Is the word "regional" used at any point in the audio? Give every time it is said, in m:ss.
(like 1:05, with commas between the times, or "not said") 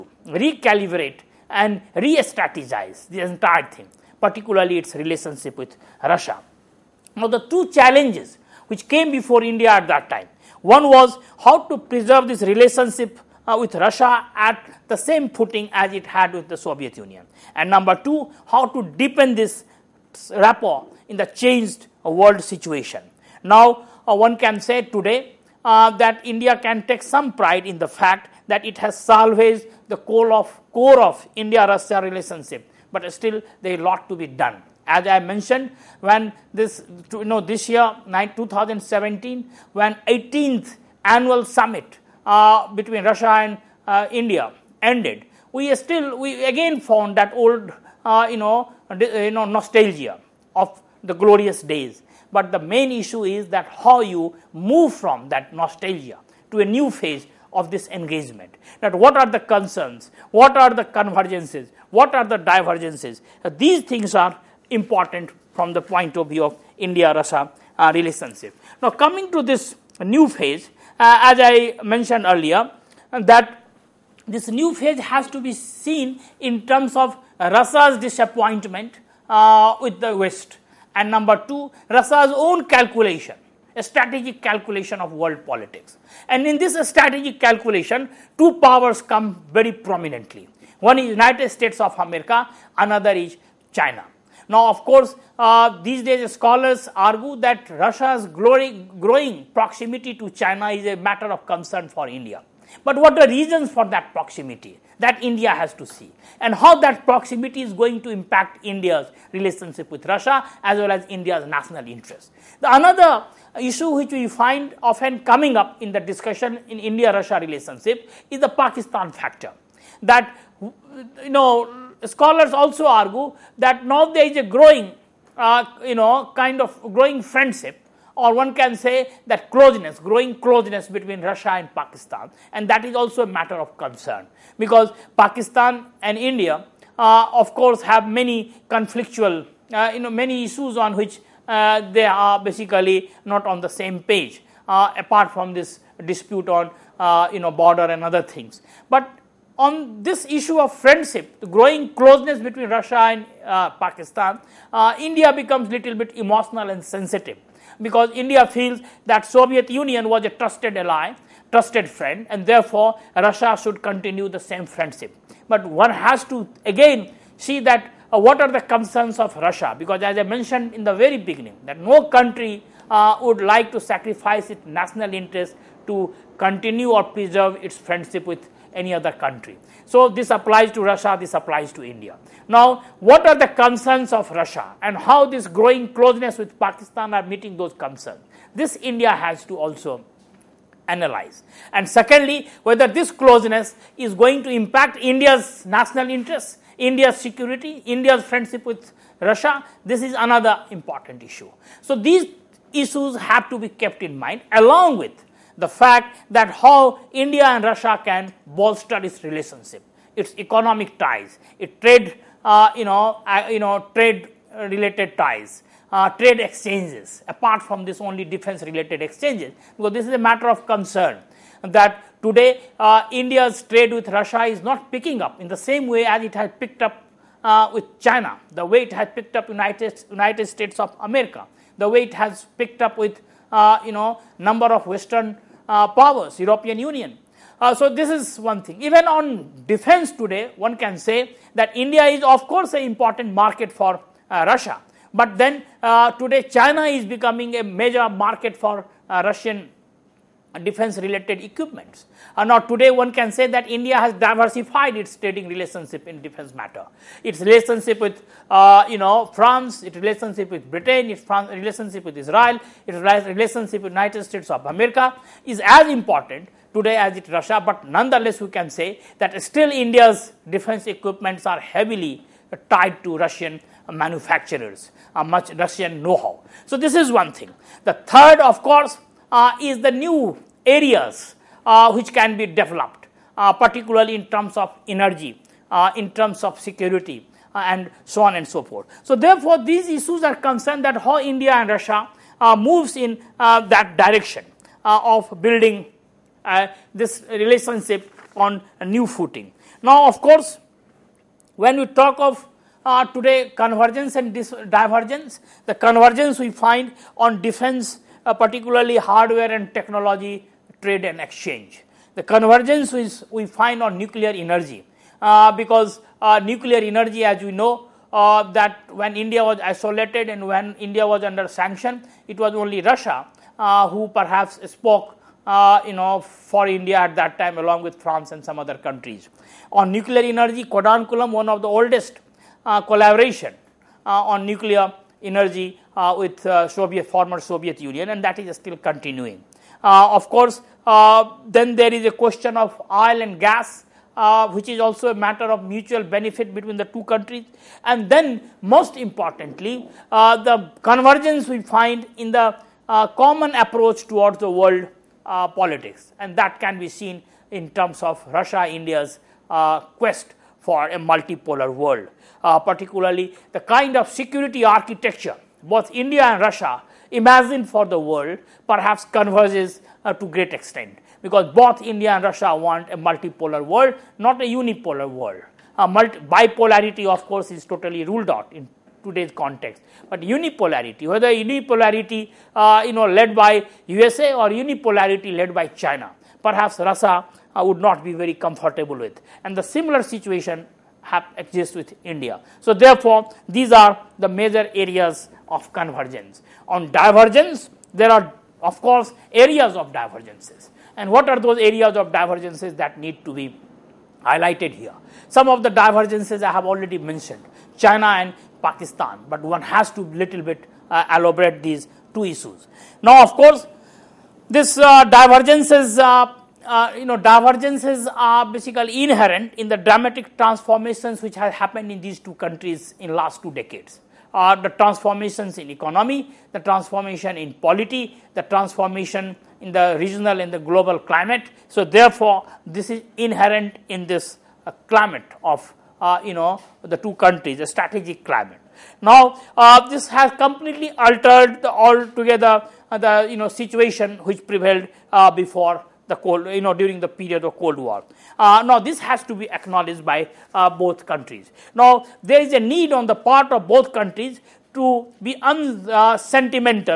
7:09.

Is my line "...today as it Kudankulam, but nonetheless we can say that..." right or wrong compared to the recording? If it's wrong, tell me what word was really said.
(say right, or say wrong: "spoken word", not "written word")
wrong: "Russia", not "Kudankulam".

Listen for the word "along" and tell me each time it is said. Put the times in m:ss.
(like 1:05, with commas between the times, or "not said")
3:24, 5:27.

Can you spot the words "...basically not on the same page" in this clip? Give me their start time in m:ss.
2:22.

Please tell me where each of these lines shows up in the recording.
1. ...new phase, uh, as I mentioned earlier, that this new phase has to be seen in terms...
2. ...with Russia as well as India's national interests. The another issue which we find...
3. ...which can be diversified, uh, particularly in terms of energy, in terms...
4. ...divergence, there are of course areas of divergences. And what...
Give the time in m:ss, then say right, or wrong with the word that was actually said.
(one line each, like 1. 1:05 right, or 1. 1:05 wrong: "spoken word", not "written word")
1. 1:10 right
2. 1:49 right
3. 4:41 wrong: "developed", not "diversified"
4. 6:36 right.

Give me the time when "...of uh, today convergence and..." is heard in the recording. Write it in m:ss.
5:02.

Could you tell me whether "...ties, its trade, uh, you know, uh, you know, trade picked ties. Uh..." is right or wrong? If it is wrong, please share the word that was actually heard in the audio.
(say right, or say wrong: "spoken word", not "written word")
wrong: "related", not "picked".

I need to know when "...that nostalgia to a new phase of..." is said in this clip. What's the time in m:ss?
0:55.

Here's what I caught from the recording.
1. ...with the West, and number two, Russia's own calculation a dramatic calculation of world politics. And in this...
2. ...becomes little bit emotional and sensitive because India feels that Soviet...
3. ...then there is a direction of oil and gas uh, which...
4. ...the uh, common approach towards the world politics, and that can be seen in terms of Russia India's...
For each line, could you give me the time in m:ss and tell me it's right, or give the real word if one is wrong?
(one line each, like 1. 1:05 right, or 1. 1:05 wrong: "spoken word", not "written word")
1. 1:19 wrong: "strategic", not "dramatic"
2. 2:35 right
3. 5:41 wrong: "question", not "direction"
4. 5:52 right.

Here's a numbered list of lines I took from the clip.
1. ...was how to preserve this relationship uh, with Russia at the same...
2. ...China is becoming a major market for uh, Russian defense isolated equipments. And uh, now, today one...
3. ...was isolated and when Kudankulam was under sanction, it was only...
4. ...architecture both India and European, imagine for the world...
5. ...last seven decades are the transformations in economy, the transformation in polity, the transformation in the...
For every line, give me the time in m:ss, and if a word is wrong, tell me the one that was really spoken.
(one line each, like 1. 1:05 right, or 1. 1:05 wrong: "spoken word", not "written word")
1. 0:10 right
2. 4:06 wrong: "related", not "isolated"
3. 5:19 wrong: "India", not "Kudankulam"
4. 6:04 wrong: "Russia", not "European"
5. 7:03 wrong: "two", not "seven".